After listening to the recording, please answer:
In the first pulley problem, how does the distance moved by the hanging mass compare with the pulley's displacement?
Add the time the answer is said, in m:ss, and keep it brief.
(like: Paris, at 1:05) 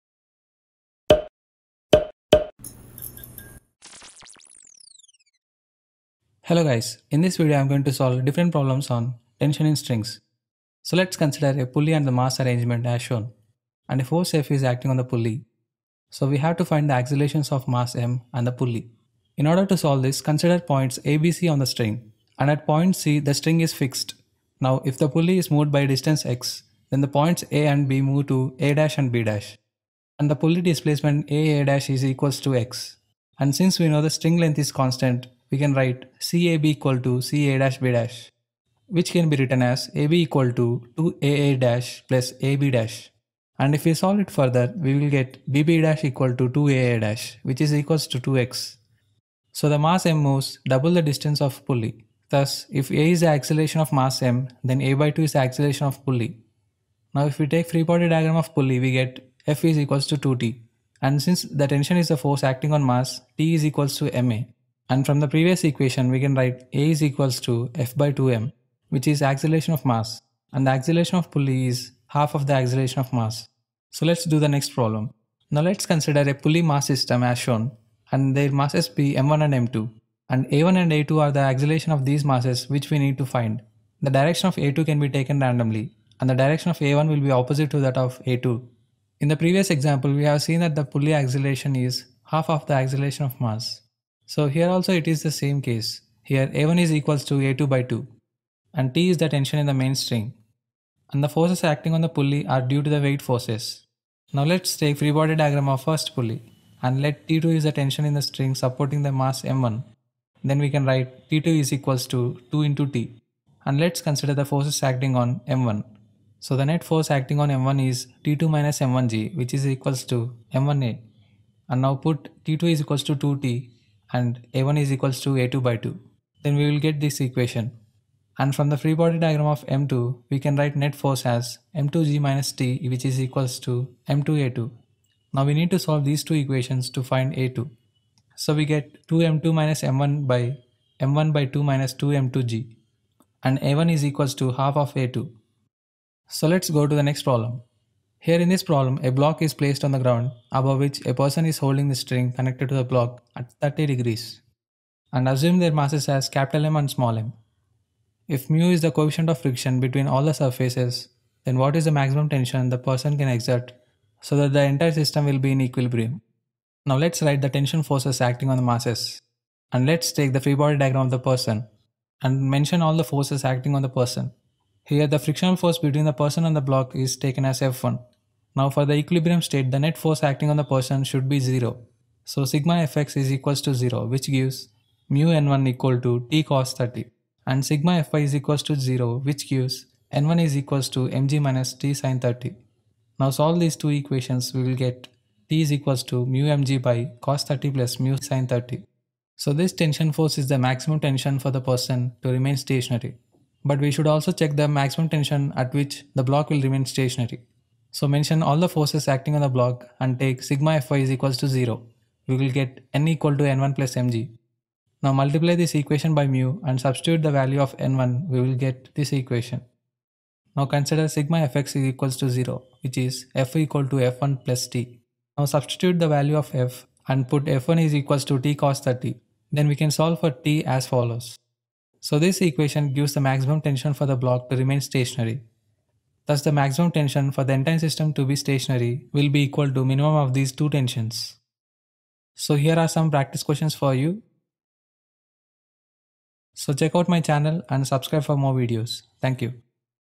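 double, at 0:50.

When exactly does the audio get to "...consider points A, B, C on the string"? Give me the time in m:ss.
0:20.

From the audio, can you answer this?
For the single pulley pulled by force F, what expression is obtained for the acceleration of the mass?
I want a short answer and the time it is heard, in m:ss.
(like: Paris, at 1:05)
F/2m, at 1:07.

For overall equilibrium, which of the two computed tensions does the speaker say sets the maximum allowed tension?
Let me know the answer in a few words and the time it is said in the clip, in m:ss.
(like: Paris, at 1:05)
minimum, at 3:59.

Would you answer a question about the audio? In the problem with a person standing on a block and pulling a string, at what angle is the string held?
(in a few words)
30 degrees.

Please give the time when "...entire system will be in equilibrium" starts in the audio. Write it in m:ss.
2:44.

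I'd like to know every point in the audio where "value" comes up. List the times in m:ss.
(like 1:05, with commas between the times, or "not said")
3:37, 3:46.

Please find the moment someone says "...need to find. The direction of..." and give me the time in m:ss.
1:22.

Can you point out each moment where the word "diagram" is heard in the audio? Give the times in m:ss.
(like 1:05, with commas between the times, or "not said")
0:58, 1:45, 2:09, 2:50.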